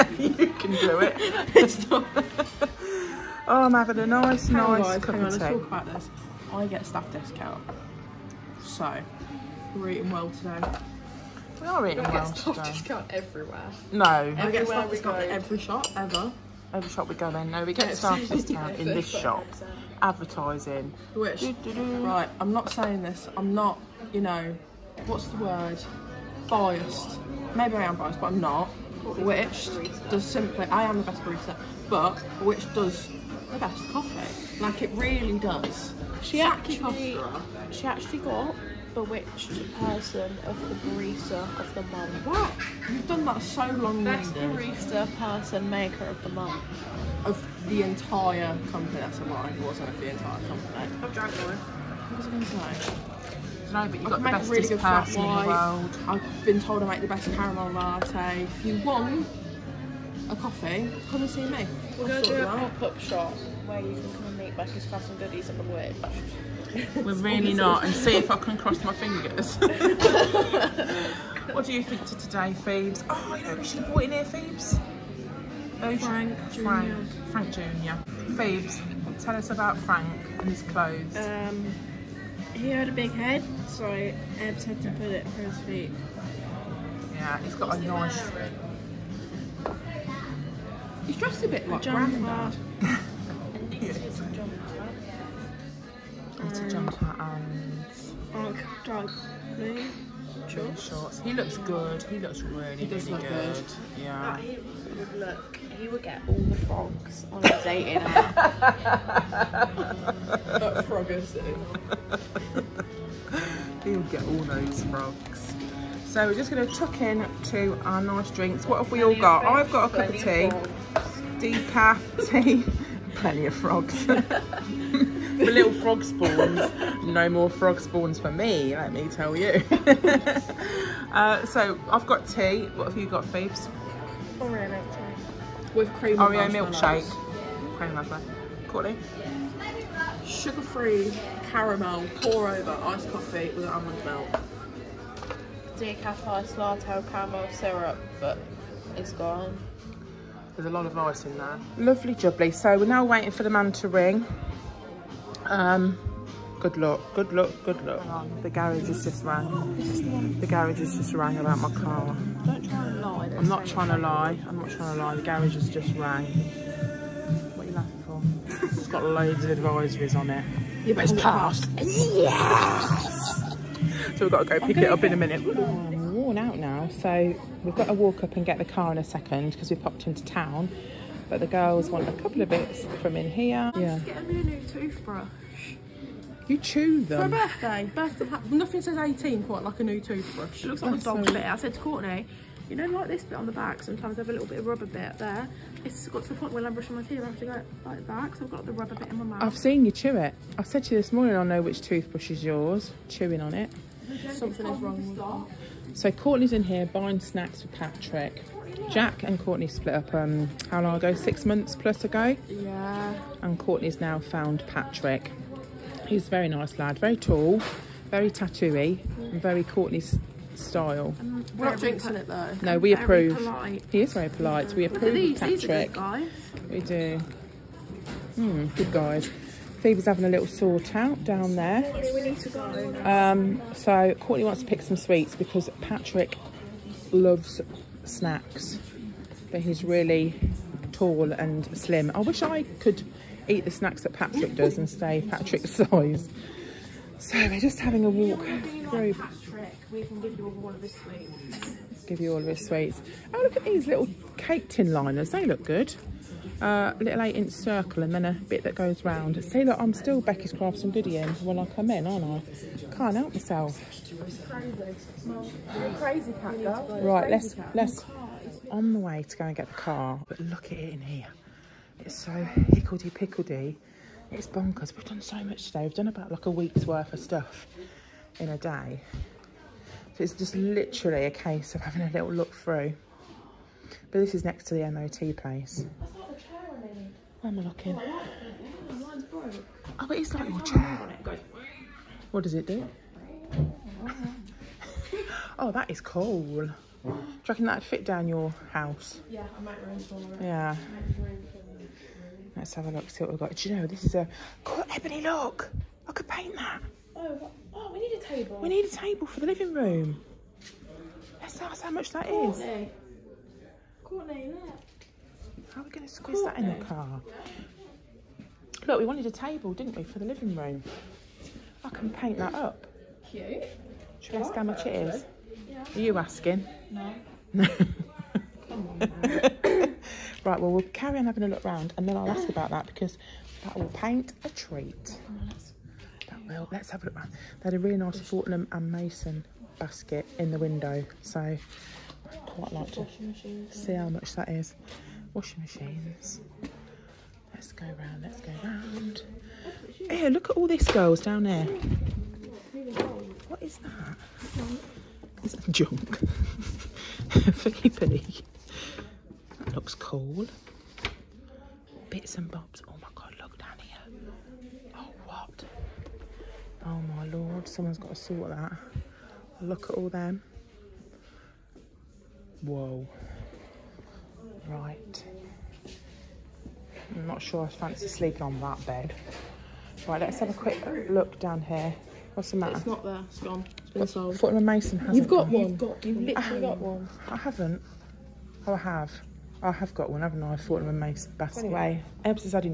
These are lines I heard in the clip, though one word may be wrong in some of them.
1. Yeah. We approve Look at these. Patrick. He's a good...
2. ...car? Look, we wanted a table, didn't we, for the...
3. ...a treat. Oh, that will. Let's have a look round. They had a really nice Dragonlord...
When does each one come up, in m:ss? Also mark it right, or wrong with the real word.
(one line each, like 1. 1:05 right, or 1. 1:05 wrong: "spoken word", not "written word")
1. 3:44 right
2. 5:16 right
3. 5:34 wrong: "Fortnum", not "Dragonlord".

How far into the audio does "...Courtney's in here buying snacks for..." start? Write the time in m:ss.
3:26.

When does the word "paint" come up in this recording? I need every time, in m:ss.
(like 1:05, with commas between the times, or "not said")
5:06, 5:22, 5:33.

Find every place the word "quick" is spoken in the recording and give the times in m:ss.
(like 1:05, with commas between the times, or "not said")
6:20.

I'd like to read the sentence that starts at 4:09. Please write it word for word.
Patrick, we can give you all of sweets.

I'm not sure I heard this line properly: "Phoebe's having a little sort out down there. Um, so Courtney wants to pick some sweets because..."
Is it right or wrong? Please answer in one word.
right.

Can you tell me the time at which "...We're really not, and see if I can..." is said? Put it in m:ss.
1:07.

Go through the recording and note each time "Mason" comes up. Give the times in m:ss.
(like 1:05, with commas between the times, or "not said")
5:38, 6:24, 6:30.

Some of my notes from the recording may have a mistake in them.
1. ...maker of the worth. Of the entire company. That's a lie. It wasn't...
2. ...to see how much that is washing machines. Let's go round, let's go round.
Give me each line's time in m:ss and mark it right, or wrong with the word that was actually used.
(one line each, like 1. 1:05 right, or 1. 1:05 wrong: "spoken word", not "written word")
1. 0:45 wrong: "month", not "worth"
2. 5:42 right.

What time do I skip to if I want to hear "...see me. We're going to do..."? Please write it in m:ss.
1:01.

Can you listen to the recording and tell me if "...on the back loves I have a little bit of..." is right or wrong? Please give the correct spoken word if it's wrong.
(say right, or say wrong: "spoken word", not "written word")
wrong: "sometimes", not "loves".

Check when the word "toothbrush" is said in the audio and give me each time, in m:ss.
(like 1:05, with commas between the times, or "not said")
3:04, 3:09, 3:21.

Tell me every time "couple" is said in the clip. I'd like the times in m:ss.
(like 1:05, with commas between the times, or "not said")
3:02.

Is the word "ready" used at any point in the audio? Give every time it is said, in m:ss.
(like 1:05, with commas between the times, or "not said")
not said.